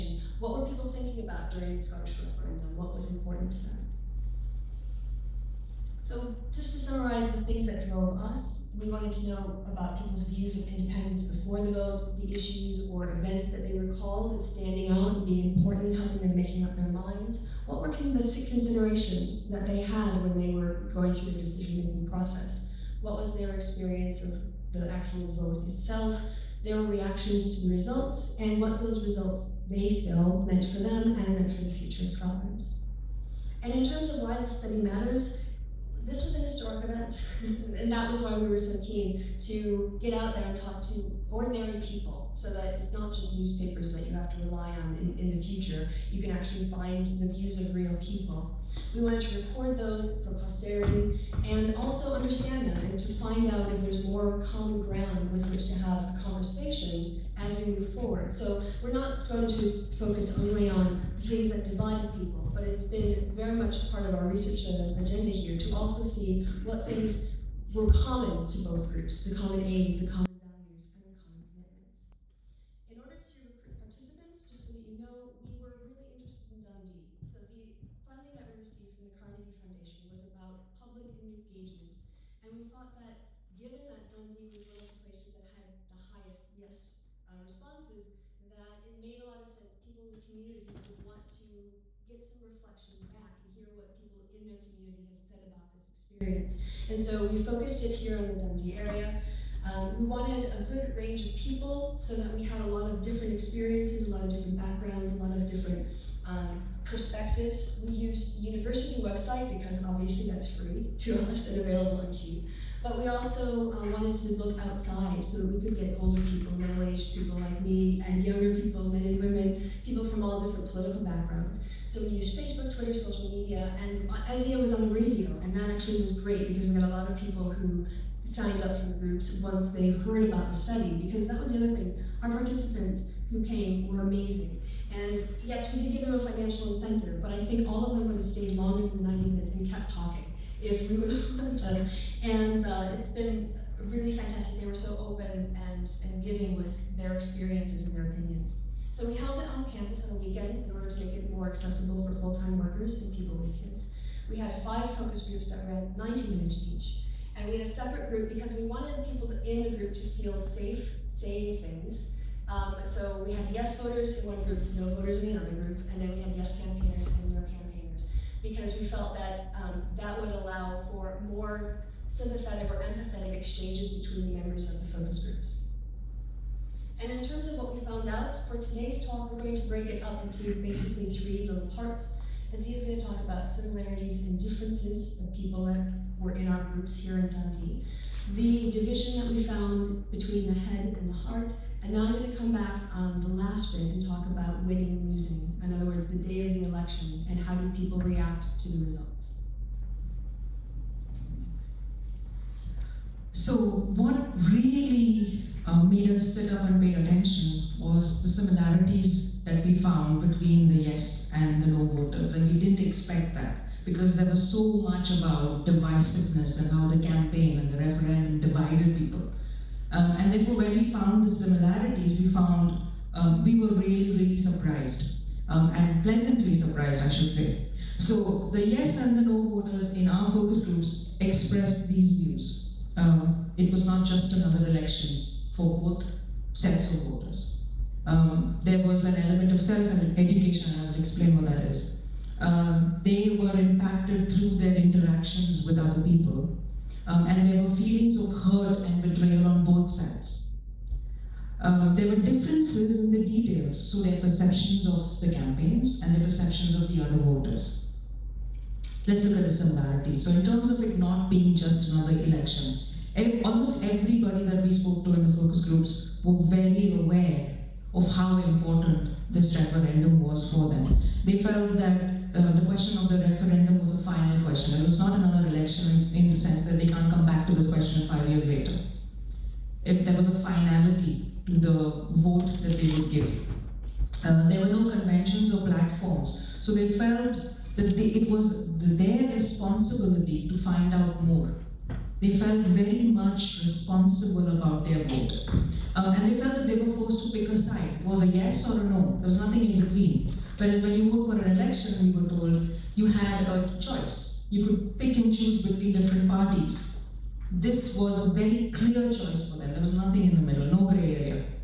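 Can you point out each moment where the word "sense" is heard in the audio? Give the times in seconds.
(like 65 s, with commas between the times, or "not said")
89 s, 276 s.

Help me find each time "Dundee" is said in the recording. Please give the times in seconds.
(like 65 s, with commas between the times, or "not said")
76 s, 84 s, 98 s, 187 s.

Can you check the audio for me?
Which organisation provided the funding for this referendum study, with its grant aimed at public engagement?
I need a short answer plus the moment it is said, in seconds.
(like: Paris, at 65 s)
Carnegie Foundation, at 79 s.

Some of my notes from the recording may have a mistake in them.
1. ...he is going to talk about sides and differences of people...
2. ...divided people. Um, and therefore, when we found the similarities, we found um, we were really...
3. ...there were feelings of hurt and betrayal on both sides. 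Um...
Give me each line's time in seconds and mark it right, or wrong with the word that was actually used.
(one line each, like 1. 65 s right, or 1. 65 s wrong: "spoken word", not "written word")
1. 182 s wrong: "similarities", not "sides"
2. 218 s right
3. 247 s right.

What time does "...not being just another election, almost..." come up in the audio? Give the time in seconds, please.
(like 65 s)
260 s.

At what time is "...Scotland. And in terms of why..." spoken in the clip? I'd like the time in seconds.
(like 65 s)
32 s.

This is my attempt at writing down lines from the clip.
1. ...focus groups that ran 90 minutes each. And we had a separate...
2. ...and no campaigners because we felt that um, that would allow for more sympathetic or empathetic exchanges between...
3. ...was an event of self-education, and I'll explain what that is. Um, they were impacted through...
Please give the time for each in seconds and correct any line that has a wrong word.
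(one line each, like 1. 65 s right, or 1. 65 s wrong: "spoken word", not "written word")
1. 154 s right
2. 167 s right
3. 238 s wrong: "element", not "event".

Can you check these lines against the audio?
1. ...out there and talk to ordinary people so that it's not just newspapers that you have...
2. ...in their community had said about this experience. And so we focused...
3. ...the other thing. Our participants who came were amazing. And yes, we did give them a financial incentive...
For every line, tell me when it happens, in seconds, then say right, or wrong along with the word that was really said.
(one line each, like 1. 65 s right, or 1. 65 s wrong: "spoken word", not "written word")
1. 40 s right
2. 94 s right
3. 131 s right.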